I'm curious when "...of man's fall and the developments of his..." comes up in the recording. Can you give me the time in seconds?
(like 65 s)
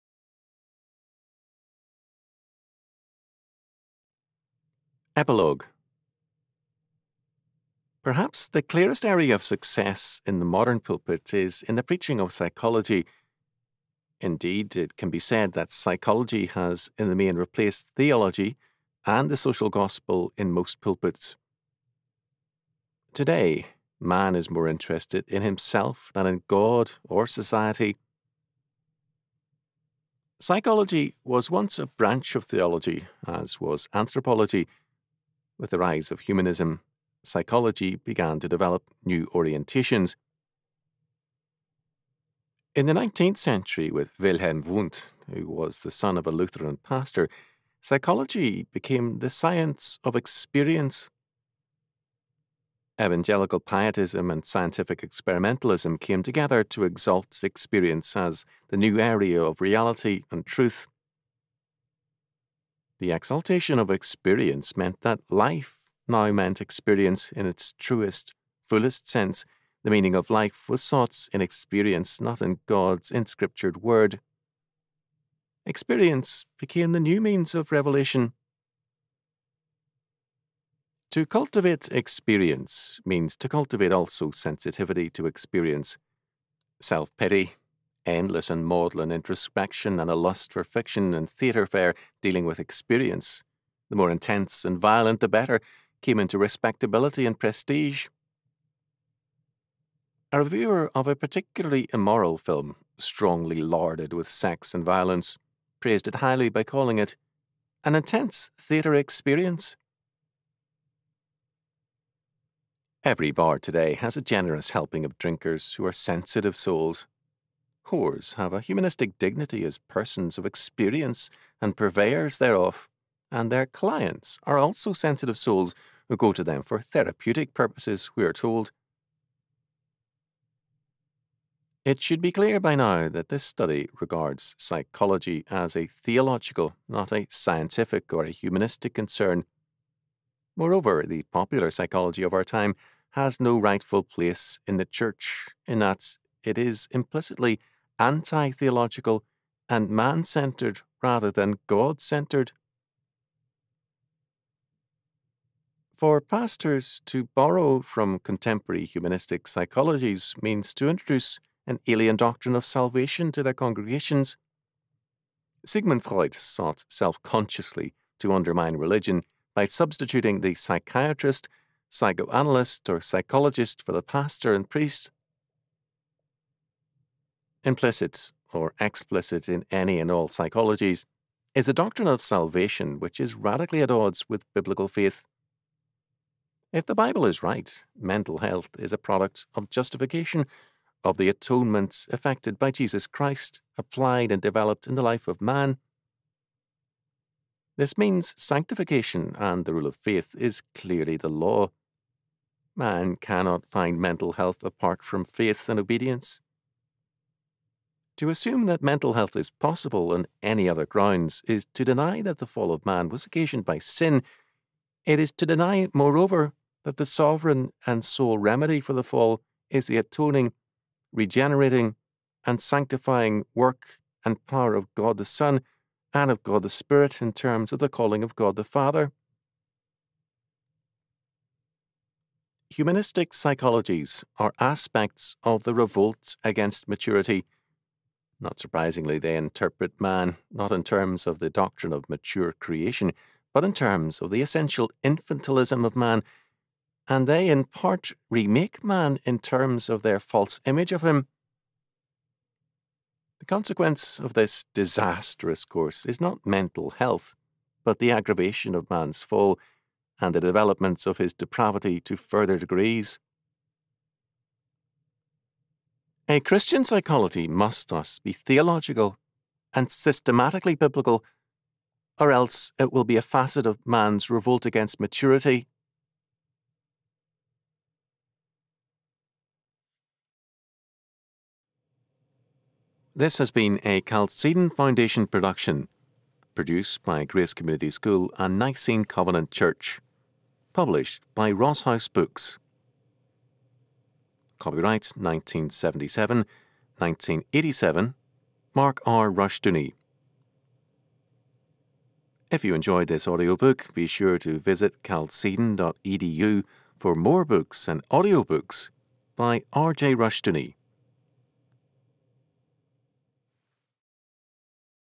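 258 s.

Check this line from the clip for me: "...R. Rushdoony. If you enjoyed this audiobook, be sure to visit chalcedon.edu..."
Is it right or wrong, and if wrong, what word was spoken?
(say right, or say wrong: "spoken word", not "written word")
right.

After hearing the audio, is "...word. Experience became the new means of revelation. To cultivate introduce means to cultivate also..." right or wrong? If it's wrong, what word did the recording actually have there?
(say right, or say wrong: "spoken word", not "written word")
wrong: "experience", not "introduce".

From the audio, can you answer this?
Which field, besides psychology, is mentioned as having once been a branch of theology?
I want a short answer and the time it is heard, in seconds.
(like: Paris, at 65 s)
anthropology, at 33 s.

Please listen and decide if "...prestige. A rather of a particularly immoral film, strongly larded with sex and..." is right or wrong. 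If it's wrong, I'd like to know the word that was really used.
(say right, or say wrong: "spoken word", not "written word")
wrong: "reviewer", not "rather".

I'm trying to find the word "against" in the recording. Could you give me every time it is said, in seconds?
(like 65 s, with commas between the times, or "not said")
236 s, 274 s.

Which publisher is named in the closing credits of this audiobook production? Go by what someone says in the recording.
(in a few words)
Ross House Books.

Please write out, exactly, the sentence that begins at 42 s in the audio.
In the 19th century, with Wilhelm Wundt, who was the son of a Lutheran pastor, psychology became the science of experience.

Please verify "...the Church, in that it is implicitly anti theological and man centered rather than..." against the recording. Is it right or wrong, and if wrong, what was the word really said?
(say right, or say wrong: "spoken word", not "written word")
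right.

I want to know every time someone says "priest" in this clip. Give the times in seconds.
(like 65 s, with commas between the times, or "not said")
174 s.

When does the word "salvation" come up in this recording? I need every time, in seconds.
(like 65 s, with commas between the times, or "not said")
162 s, 182 s.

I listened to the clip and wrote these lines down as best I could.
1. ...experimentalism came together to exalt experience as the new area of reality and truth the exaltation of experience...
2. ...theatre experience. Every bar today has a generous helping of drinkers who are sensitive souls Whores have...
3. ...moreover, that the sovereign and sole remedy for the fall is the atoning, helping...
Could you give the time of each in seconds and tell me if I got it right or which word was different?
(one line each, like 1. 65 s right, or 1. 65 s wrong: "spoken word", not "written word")
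1. 55 s right
2. 108 s right
3. 215 s wrong: "regenerating", not "helping".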